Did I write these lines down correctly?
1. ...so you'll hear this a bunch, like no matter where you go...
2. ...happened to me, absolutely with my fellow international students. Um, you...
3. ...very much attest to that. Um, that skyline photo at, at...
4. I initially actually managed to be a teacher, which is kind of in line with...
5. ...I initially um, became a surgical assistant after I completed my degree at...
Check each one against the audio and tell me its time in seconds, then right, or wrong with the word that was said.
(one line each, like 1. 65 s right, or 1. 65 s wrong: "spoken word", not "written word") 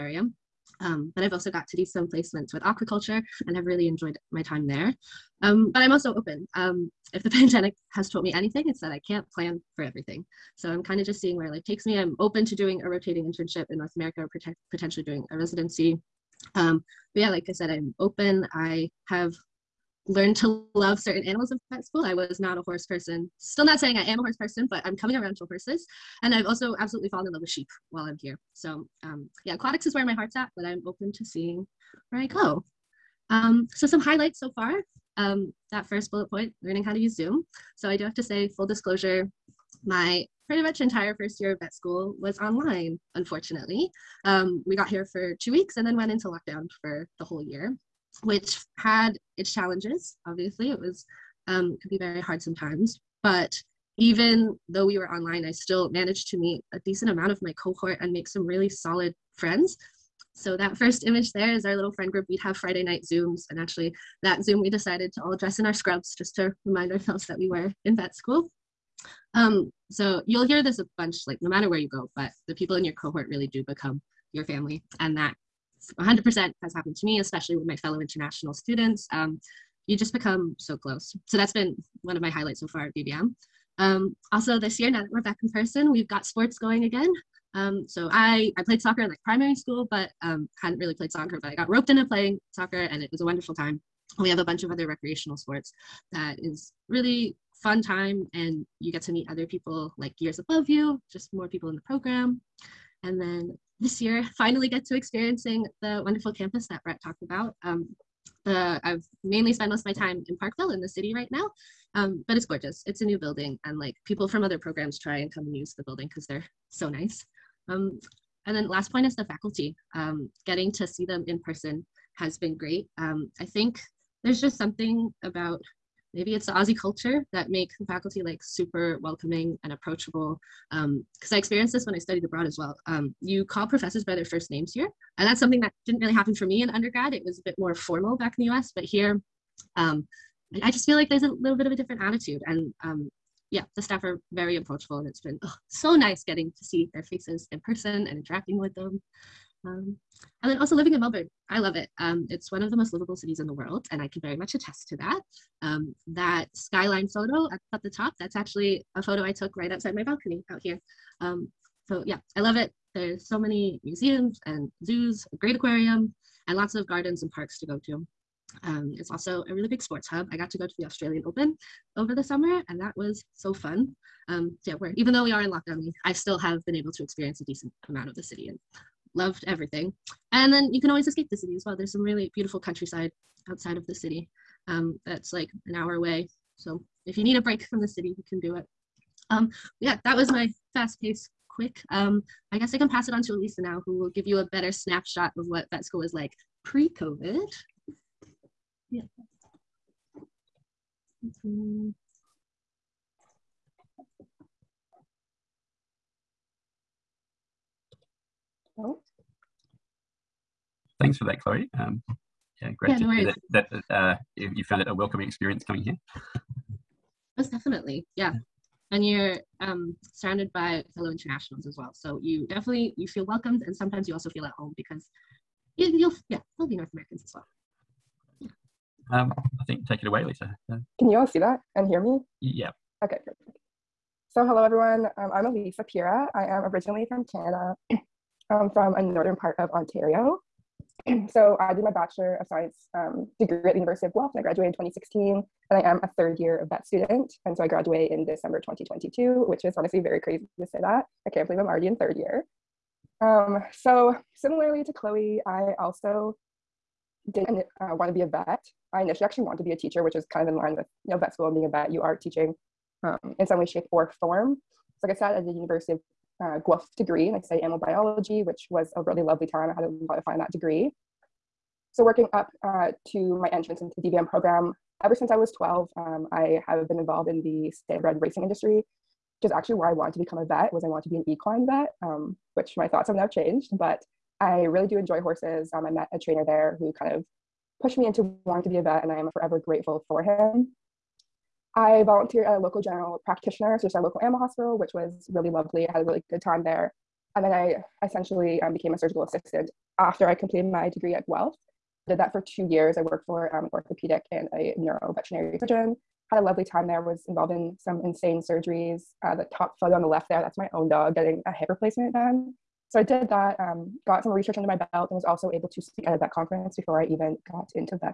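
1. 69 s right
2. 76 s wrong: "especially", not "absolutely"
3. 154 s right
4. 258 s wrong: "wanted", not "managed"
5. 297 s wrong: "essentially", not "initially".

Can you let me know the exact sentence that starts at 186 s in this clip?
So if you need a break from the city, you can do it.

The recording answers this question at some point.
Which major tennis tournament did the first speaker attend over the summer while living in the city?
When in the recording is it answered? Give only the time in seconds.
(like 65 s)
170 s.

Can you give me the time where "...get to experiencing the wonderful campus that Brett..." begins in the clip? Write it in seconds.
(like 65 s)
104 s.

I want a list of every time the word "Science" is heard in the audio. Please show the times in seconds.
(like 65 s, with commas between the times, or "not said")
242 s.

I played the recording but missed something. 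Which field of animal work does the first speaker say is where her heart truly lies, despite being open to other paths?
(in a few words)
Aquatics.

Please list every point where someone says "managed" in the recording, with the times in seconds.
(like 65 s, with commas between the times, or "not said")
55 s.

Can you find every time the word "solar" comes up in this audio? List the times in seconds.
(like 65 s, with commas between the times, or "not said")
not said.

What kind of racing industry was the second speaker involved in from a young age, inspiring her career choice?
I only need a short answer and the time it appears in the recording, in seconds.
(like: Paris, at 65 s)
Standardbred racing, at 277 s.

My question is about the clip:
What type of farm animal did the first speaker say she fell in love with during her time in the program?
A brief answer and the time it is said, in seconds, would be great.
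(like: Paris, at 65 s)
Sheep, at 27 s.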